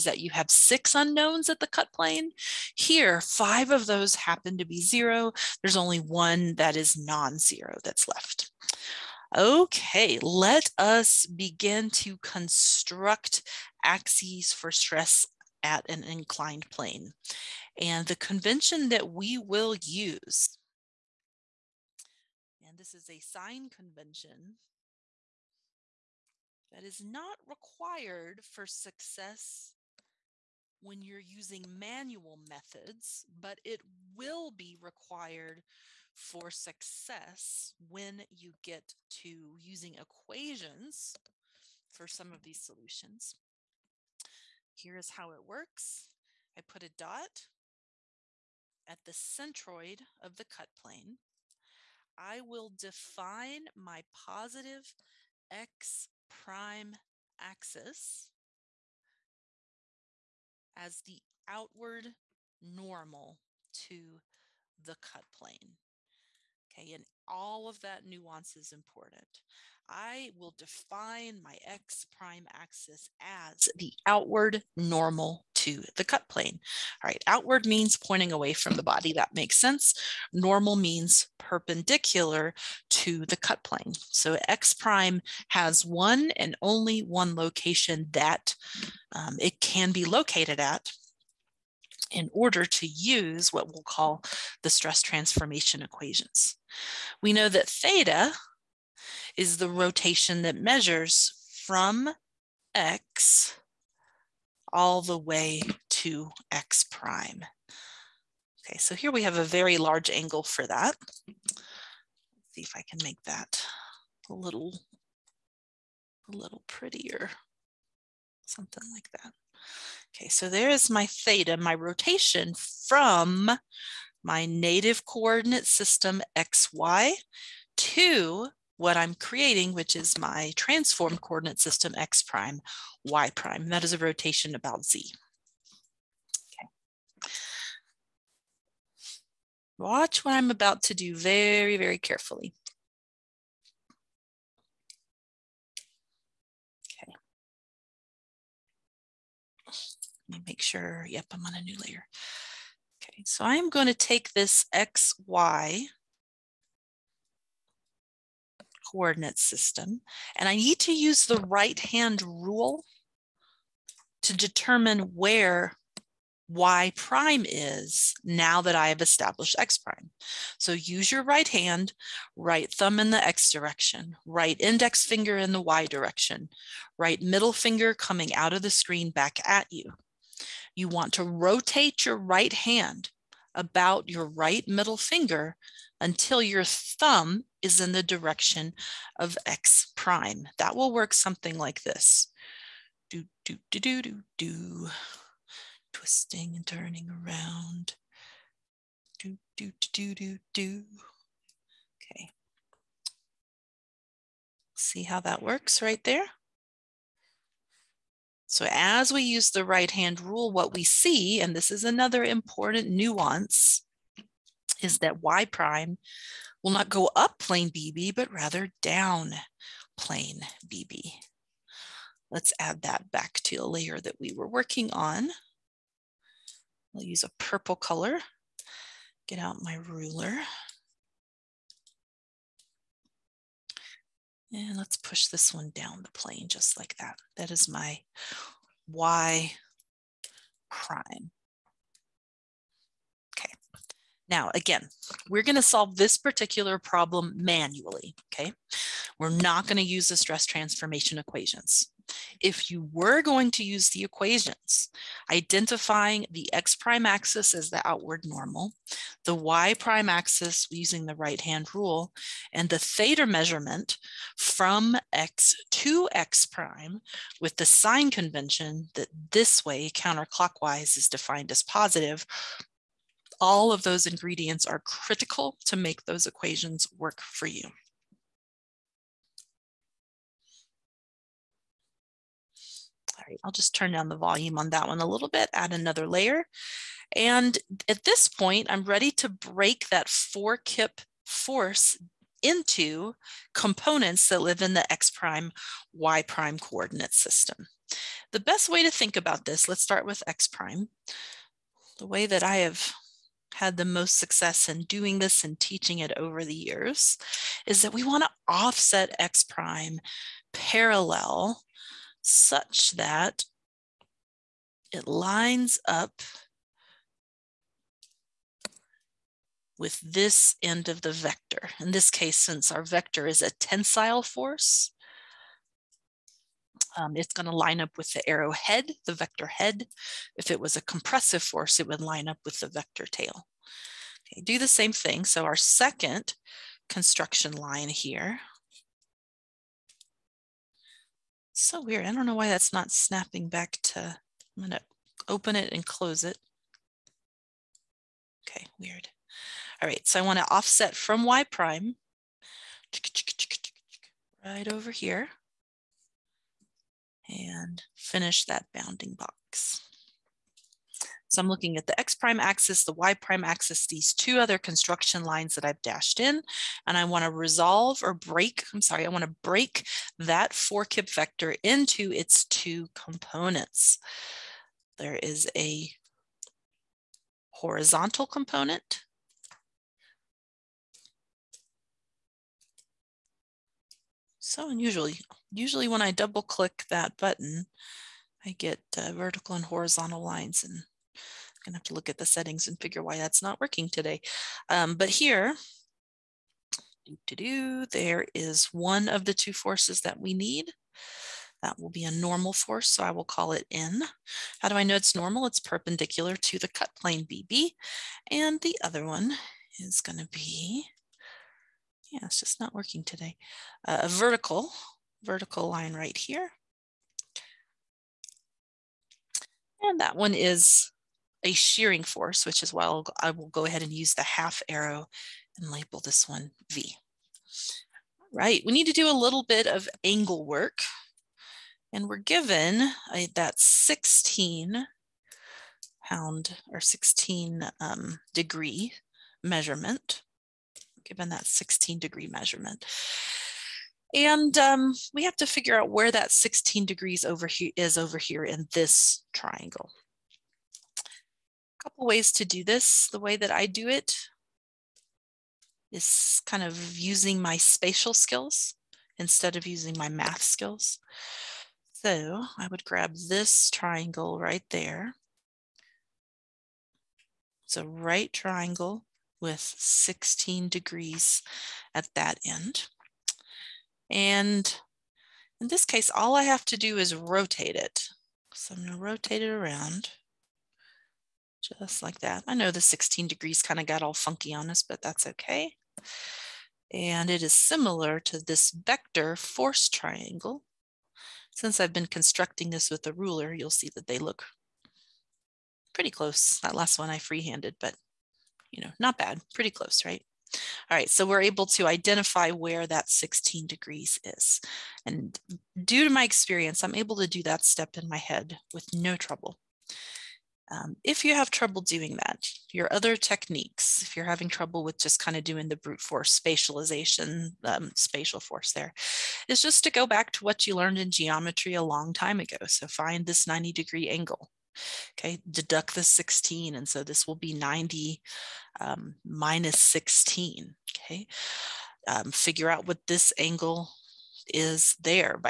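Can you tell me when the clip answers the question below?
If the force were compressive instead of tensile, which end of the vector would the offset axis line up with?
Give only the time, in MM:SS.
05:32.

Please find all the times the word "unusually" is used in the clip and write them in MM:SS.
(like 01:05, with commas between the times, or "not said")
06:24.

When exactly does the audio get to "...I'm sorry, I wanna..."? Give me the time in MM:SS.
06:08.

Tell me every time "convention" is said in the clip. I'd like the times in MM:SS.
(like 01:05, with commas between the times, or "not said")
00:18, 00:23, 04:28.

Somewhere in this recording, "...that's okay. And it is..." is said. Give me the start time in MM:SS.
08:05.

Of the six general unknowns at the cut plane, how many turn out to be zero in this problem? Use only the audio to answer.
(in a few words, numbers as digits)
5.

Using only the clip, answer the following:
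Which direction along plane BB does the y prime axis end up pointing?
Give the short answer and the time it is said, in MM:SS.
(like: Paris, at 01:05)
Down plane BB, at 03:38.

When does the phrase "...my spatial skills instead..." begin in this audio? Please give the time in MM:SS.
07:37.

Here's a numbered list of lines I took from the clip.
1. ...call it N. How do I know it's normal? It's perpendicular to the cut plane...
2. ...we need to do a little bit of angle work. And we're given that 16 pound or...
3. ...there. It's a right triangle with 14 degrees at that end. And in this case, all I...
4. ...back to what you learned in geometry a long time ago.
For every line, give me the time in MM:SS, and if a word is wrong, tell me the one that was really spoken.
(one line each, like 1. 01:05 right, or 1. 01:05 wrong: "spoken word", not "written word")
1. 06:43 right
2. 07:08 right
3. 07:44 wrong: "16", not "14"
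4. 08:40 right.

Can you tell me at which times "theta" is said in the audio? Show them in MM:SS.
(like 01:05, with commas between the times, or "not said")
01:37, 02:01, 04:22.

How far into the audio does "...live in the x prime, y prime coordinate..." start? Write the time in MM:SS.
04:54.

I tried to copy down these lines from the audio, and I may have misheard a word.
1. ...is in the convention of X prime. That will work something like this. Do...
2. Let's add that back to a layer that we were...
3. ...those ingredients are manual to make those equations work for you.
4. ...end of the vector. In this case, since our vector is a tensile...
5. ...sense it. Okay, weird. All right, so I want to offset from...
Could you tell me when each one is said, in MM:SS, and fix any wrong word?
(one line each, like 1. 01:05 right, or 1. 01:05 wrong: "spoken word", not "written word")
1. 03:07 wrong: "direction", not "convention"
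2. 03:42 right
3. 04:33 wrong: "critical", not "manual"
4. 05:20 right
5. 05:45 wrong: "close", not "sense".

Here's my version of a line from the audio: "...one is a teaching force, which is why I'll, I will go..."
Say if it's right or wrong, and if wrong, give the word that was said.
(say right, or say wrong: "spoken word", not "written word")
wrong: "shearing", not "teaching".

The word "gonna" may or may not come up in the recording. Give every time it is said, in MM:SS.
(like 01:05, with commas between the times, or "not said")
04:05, 04:09.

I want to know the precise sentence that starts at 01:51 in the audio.
Let's see if I can make that a little, a little prettier, something like that.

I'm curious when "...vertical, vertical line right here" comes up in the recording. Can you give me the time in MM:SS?
06:54.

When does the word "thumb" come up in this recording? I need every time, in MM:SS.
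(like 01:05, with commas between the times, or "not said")
02:52, 03:06.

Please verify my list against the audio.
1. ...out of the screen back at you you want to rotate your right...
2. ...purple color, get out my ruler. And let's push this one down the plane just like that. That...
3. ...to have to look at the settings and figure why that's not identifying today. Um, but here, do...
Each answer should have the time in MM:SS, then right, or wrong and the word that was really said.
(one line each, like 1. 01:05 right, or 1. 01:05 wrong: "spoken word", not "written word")
1. 02:58 right
2. 03:47 right
3. 06:31 wrong: "working", not "identifying".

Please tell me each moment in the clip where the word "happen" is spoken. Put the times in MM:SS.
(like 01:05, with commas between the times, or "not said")
00:04.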